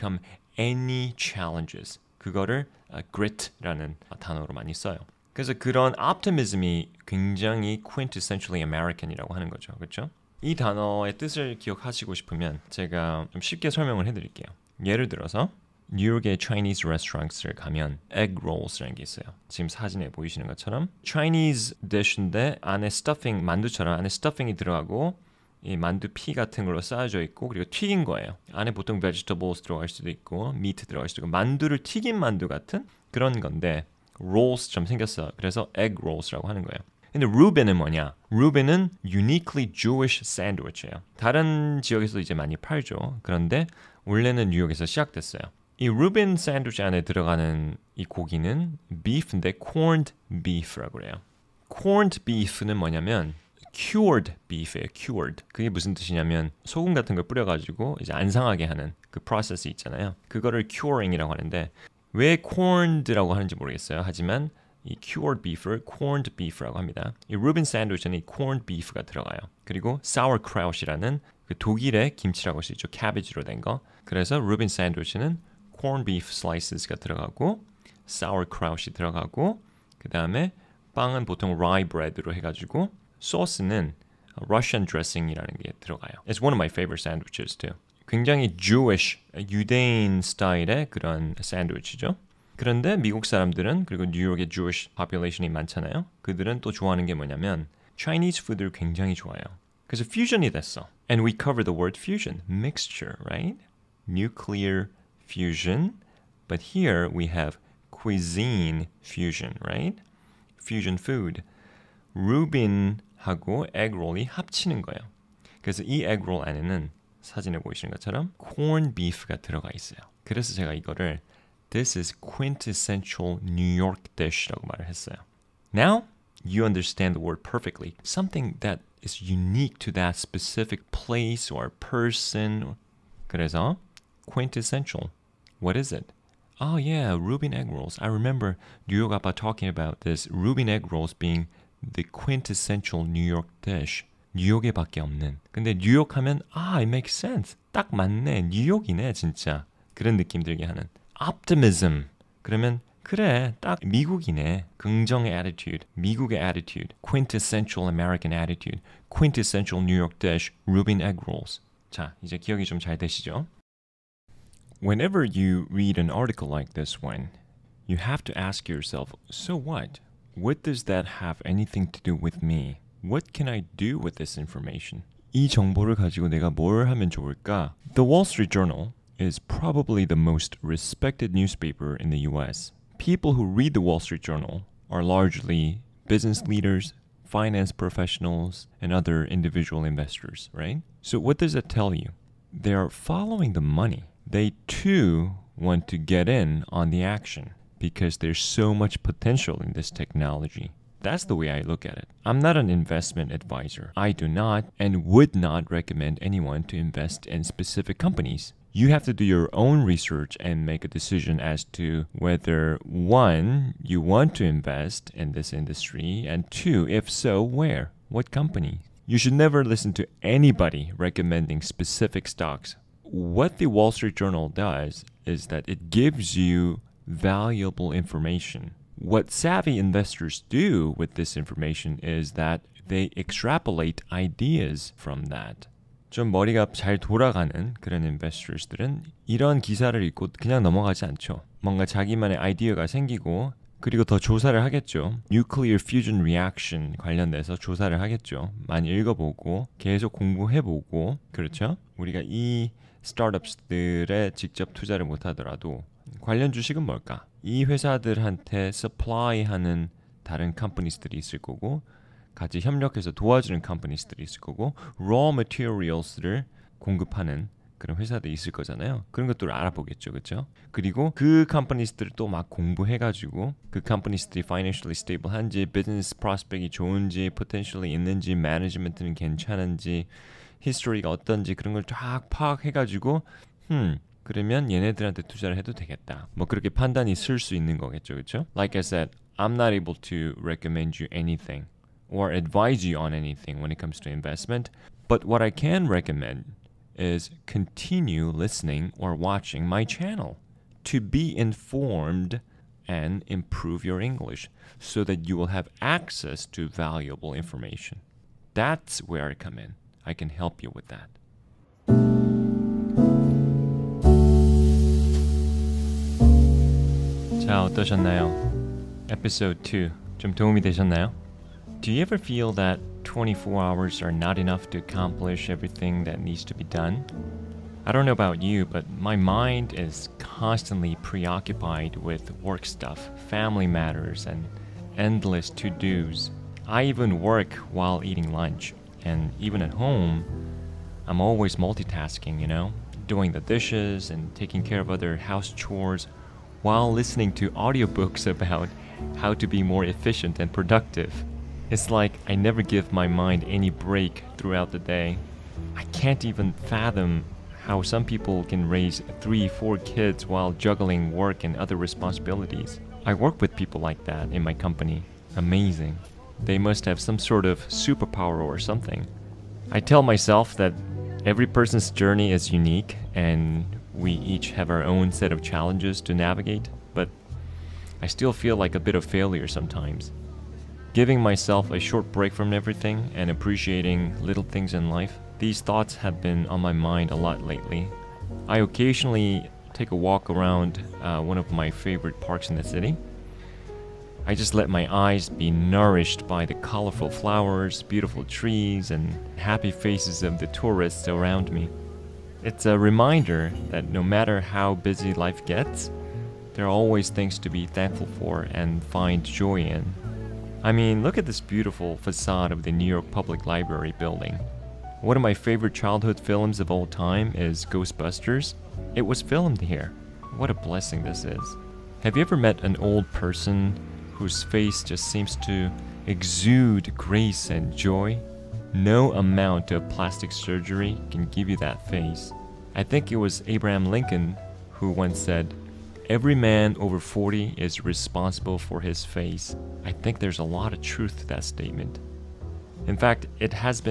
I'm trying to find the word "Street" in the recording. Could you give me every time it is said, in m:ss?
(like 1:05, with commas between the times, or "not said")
2:58, 3:04, 3:43.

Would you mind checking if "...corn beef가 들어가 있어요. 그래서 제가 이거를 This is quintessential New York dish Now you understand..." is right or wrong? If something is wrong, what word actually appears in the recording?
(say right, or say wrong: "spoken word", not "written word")
right.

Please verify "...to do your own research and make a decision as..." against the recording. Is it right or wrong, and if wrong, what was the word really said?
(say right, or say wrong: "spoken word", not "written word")
right.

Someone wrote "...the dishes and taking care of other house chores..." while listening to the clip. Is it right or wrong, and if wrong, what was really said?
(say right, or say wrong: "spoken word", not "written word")
right.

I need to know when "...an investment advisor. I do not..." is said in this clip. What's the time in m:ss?
3:22.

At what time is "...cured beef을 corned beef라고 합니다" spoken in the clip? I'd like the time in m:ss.
1:05.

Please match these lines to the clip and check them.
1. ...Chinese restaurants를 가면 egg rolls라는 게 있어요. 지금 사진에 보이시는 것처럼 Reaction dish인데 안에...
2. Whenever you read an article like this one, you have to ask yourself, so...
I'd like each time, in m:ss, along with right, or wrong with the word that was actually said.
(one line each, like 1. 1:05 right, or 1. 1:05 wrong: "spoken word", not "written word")
1. 0:16 wrong: "Chinese", not "Reaction"
2. 2:44 right.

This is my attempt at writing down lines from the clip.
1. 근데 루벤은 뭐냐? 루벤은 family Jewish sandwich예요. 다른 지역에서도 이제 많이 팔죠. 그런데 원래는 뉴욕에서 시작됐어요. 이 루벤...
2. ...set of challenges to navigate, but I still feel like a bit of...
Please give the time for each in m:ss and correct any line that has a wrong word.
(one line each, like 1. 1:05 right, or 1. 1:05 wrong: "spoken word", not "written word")
1. 0:37 wrong: "uniquely", not "family"
2. 6:15 right.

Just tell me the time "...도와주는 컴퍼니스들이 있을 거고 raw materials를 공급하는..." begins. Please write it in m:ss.
4:23.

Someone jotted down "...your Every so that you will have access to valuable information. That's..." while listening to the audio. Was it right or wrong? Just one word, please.
wrong.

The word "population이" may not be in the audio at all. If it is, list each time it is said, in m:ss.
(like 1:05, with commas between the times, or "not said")
1:34.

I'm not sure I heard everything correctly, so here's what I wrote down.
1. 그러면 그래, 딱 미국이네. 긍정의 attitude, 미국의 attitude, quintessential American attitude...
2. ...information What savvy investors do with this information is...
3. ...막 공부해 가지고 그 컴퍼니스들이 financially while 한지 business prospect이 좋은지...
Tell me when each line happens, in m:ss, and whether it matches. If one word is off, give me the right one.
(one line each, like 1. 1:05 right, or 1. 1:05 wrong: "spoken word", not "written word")
1. 2:32 right
2. 3:47 right
3. 4:32 wrong: "stable", not "while".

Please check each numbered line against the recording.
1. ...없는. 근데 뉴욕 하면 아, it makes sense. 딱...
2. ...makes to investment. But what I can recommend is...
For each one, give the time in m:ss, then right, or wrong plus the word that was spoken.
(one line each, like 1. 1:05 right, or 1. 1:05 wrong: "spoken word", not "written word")
1. 2:25 right
2. 4:53 wrong: "comes", not "makes".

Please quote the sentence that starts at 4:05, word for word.
Nuclear Fusion Reaction 관련돼서 조사를 하겠죠.